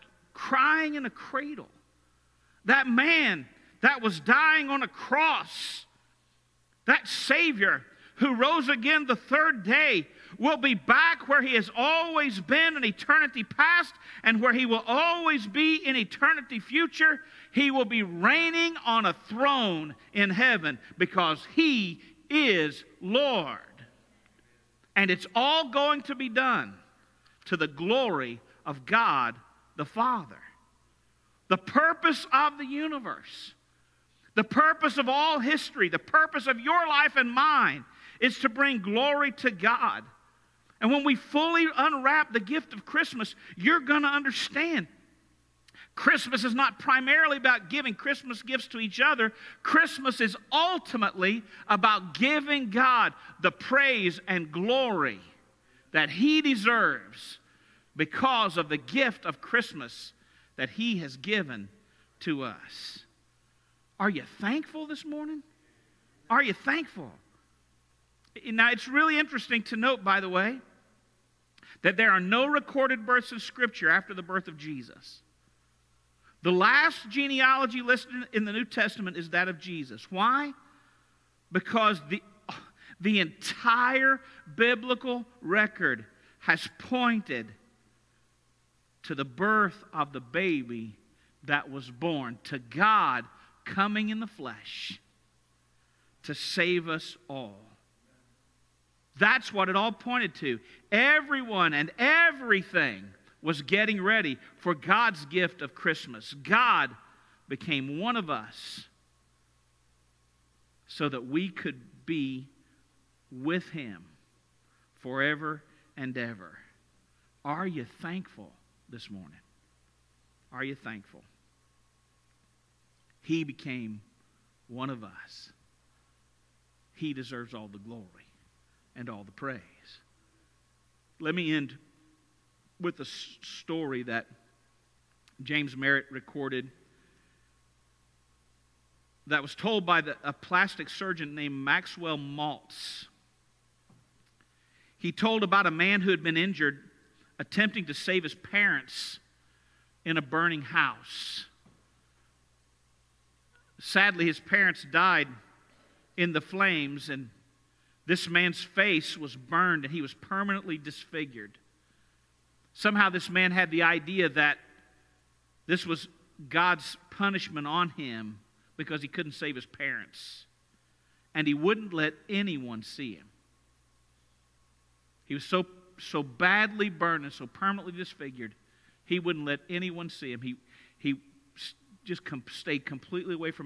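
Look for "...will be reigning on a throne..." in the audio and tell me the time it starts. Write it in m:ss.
0:17.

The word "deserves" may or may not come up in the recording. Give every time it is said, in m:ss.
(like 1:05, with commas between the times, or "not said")
0:56, 2:07.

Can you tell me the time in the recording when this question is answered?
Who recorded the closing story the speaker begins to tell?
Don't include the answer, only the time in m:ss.
2:15.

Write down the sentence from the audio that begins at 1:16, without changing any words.
The last genealogy listed in the New Testament is that of Jesus.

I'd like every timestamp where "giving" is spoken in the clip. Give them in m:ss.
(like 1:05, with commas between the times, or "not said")
0:47, 0:52.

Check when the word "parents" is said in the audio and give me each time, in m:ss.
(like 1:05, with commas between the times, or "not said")
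2:28, 2:34, 2:49.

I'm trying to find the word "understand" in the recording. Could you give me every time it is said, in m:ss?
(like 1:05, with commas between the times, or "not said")
0:44.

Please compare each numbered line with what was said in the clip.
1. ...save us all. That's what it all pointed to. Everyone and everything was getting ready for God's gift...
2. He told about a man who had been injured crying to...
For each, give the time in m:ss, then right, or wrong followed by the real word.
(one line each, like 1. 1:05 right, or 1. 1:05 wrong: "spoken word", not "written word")
1. 1:36 right
2. 2:24 wrong: "attempting", not "crying".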